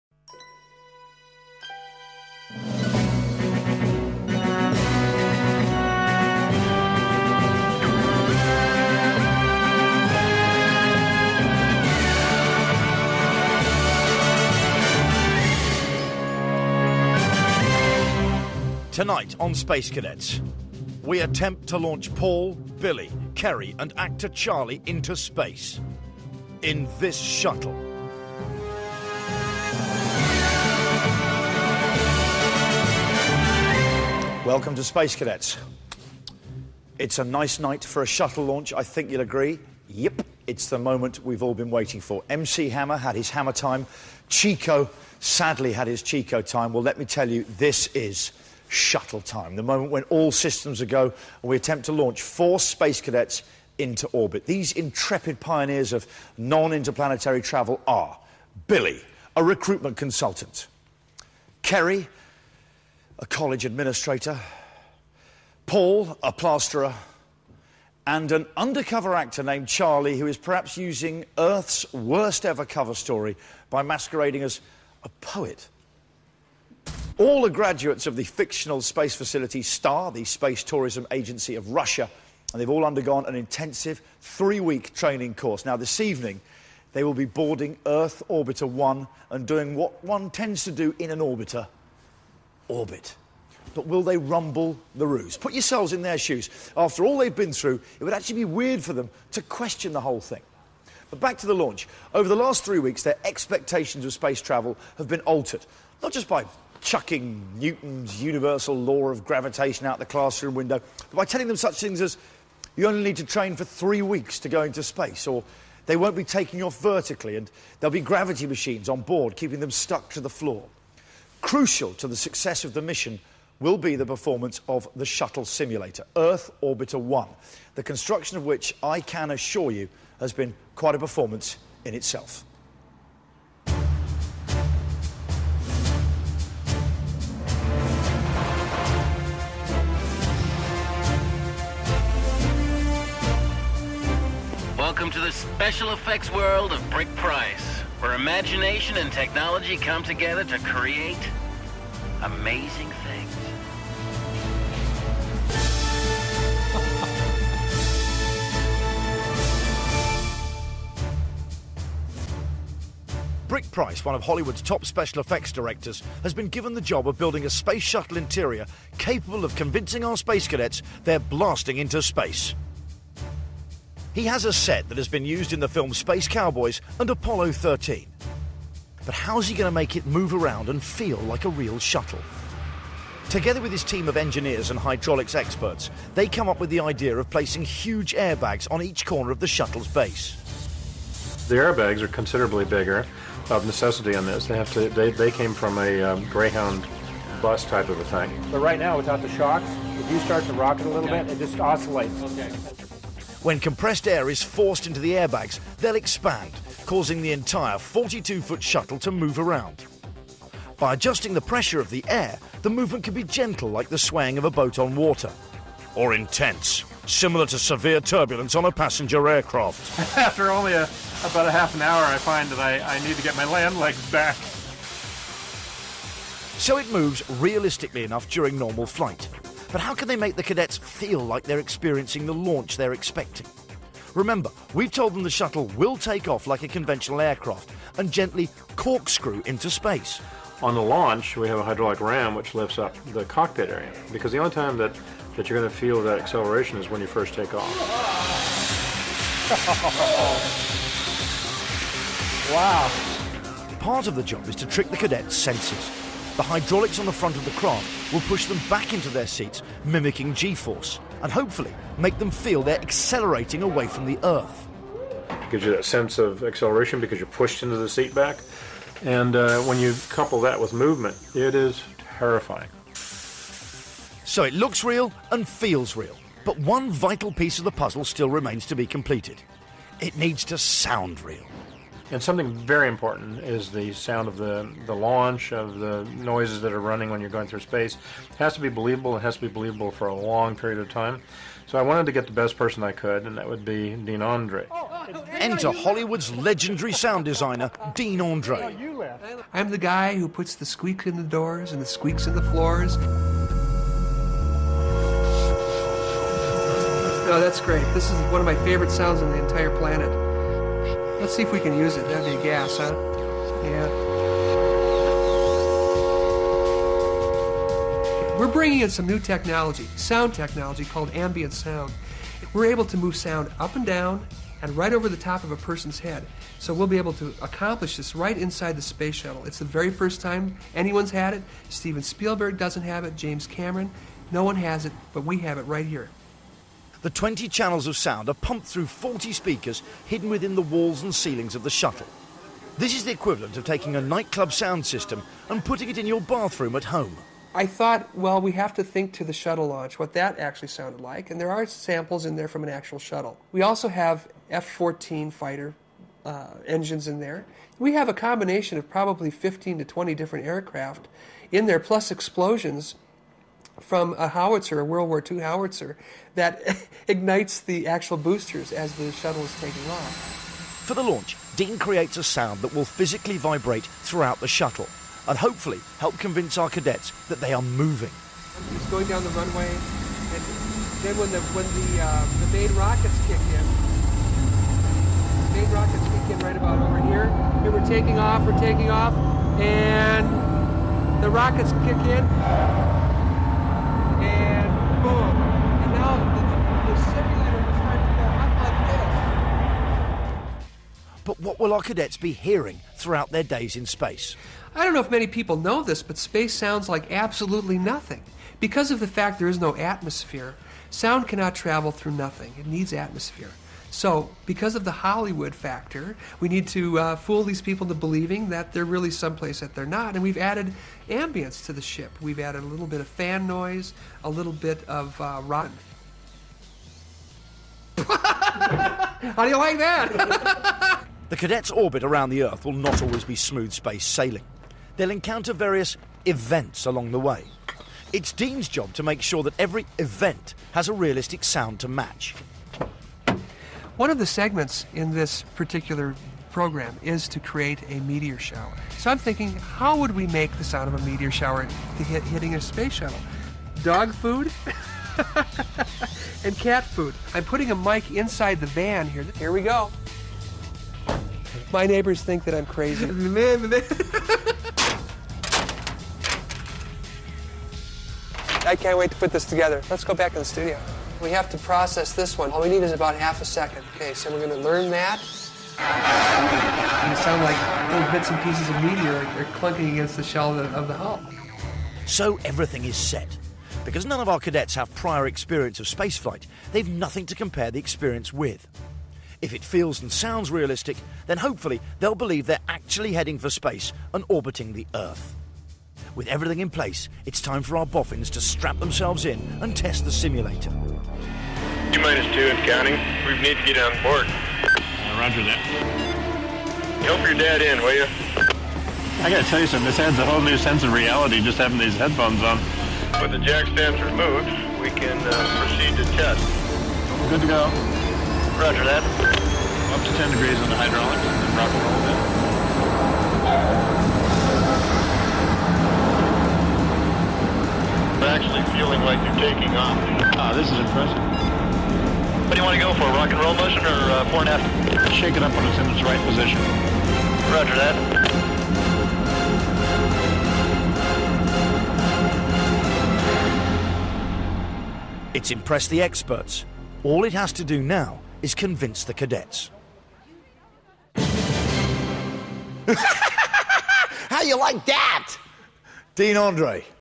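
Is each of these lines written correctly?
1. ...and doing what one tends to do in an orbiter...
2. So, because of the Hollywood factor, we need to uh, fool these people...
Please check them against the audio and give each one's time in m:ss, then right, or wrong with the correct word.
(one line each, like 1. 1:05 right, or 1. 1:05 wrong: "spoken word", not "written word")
1. 1:29 right
2. 6:53 right.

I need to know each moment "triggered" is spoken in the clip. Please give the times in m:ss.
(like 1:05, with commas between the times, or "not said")
not said.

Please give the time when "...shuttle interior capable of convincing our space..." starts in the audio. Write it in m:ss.
2:47.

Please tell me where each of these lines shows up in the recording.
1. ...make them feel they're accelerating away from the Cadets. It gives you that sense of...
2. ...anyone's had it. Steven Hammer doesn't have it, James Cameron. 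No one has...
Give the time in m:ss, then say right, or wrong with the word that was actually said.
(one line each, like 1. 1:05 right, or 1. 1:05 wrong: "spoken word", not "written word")
1. 4:21 wrong: "Earth", not "Cadets"
2. 5:30 wrong: "Spielberg", not "Hammer".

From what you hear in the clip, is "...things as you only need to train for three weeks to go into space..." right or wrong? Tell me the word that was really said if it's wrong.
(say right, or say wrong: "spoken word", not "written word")
right.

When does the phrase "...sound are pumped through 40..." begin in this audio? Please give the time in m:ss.
5:37.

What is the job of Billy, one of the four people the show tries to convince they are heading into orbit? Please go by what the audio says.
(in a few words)
Recruitment consultant.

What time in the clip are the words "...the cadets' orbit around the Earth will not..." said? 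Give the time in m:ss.
7:11.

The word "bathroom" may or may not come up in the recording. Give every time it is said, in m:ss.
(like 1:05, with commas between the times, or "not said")
5:46.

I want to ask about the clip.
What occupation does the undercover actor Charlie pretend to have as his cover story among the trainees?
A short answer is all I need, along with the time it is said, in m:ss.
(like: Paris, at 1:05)
Poet, at 1:15.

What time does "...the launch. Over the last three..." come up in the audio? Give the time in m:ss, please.
1:41.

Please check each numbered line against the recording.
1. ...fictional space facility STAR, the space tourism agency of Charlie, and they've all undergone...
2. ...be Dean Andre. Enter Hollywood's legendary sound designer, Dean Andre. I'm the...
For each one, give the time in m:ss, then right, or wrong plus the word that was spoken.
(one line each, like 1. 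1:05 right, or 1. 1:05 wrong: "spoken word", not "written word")
1. 1:18 wrong: "Russia", not "Charlie"
2. 4:53 right.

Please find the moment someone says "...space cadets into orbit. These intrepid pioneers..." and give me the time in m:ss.
0:52.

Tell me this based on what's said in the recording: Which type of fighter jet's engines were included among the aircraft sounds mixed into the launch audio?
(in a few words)
F-14.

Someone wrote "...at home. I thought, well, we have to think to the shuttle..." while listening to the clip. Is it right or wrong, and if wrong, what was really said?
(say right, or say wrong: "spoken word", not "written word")
right.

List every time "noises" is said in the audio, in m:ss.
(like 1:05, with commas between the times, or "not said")
4:46, 7:03.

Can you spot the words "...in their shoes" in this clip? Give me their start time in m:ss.
1:35.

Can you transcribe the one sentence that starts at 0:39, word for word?
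Yep, it's the moment we've all been waiting for.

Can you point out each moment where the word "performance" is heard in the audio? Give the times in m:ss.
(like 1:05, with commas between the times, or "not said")
2:04, 2:10.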